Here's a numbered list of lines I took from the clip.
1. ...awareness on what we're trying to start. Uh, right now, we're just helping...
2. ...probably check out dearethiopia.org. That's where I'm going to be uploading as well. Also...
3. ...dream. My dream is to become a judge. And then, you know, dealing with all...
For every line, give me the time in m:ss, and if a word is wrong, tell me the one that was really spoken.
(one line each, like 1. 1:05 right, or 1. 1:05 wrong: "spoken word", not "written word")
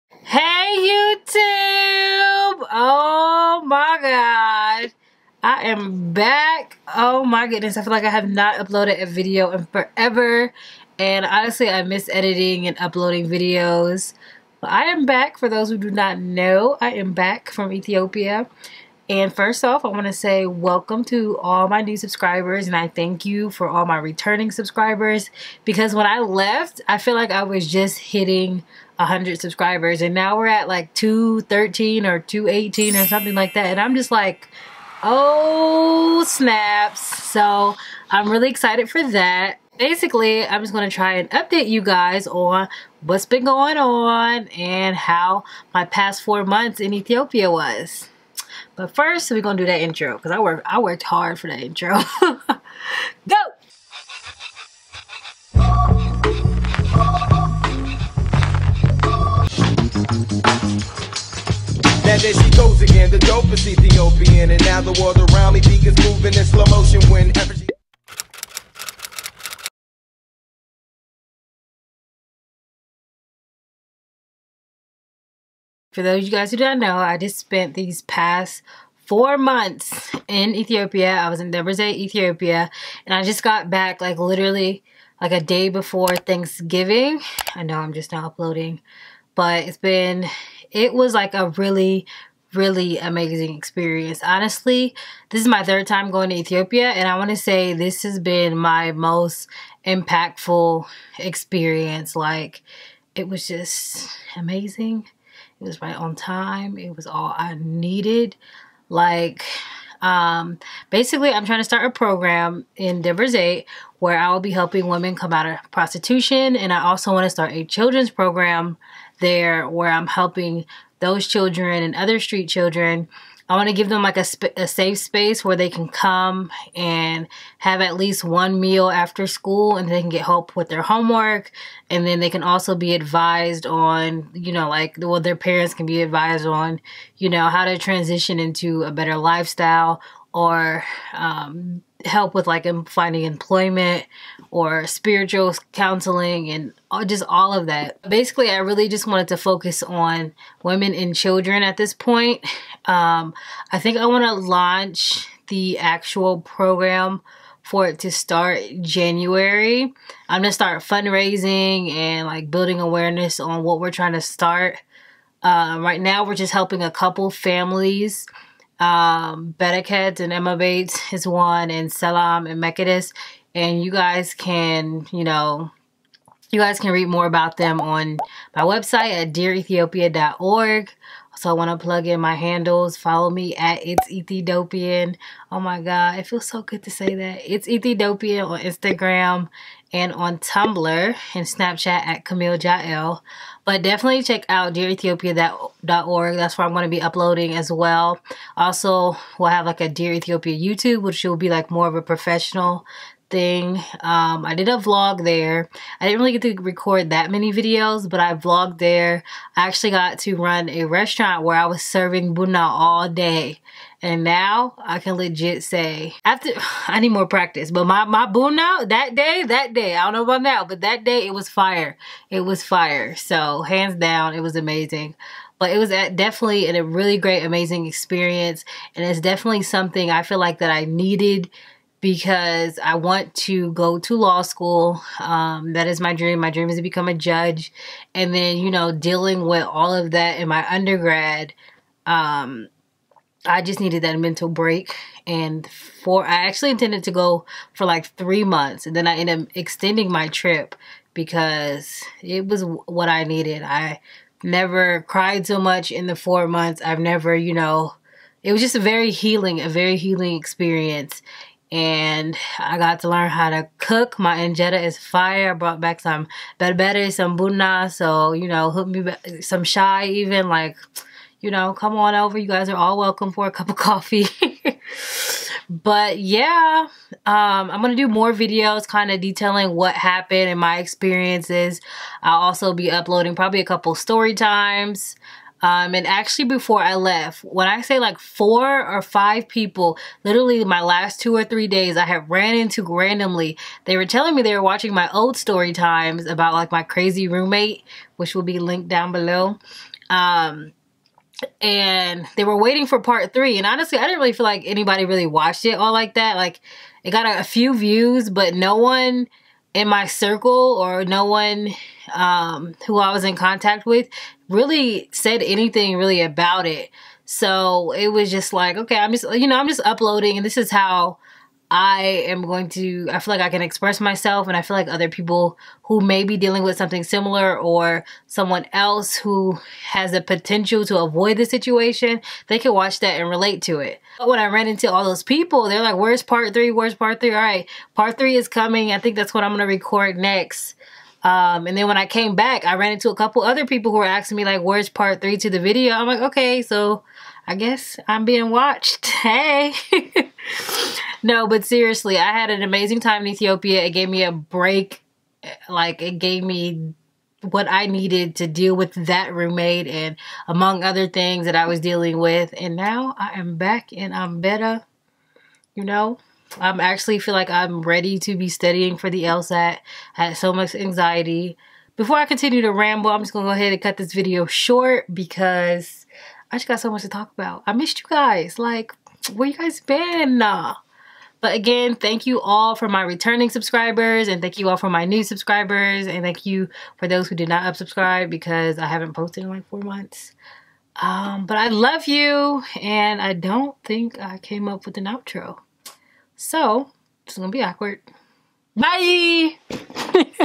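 1. 2:42 right
2. 3:13 wrong: "definitely", not "probably"
3. 3:56 right.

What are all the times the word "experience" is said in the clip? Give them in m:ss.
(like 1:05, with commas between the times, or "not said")
1:33, 1:41, 3:47, 4:20, 4:40.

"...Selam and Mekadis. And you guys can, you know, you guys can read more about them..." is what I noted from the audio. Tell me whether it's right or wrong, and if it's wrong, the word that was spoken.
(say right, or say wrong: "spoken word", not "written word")
right.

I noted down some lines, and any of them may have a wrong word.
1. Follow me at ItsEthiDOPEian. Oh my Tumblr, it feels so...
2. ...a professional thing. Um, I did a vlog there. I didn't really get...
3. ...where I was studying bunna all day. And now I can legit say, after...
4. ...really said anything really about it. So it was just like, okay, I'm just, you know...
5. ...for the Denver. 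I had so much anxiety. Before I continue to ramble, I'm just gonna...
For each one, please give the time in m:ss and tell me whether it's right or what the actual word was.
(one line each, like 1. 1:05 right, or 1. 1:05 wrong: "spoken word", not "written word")
1. 3:02 wrong: "God", not "Tumblr"
2. 3:21 right
3. 3:31 wrong: "serving", not "studying"
4. 5:14 right
5. 6:08 wrong: "LSAT", not "Denver".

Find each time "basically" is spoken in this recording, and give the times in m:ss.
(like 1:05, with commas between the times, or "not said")
0:39, 1:50, 2:28.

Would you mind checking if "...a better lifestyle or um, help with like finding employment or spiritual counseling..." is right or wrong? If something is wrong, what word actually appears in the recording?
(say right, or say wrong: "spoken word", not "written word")
right.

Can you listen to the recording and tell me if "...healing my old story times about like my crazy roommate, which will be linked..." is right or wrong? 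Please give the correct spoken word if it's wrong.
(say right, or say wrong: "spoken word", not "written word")
wrong: "watching", not "healing".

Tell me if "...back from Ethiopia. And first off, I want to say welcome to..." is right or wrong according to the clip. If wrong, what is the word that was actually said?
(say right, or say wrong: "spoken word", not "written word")
right.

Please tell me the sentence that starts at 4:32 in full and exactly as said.
You guys are all welcome for a cup of coffee.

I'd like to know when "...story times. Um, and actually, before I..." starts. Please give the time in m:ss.
4:43.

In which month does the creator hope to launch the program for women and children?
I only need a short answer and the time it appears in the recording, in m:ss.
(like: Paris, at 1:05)
January, at 2:38.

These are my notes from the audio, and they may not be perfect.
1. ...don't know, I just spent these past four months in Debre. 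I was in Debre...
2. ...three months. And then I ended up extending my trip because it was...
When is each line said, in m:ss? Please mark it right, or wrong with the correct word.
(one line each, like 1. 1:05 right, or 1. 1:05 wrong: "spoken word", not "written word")
1. 1:16 wrong: "Ethiopia", not "Debre"
2. 4:08 right.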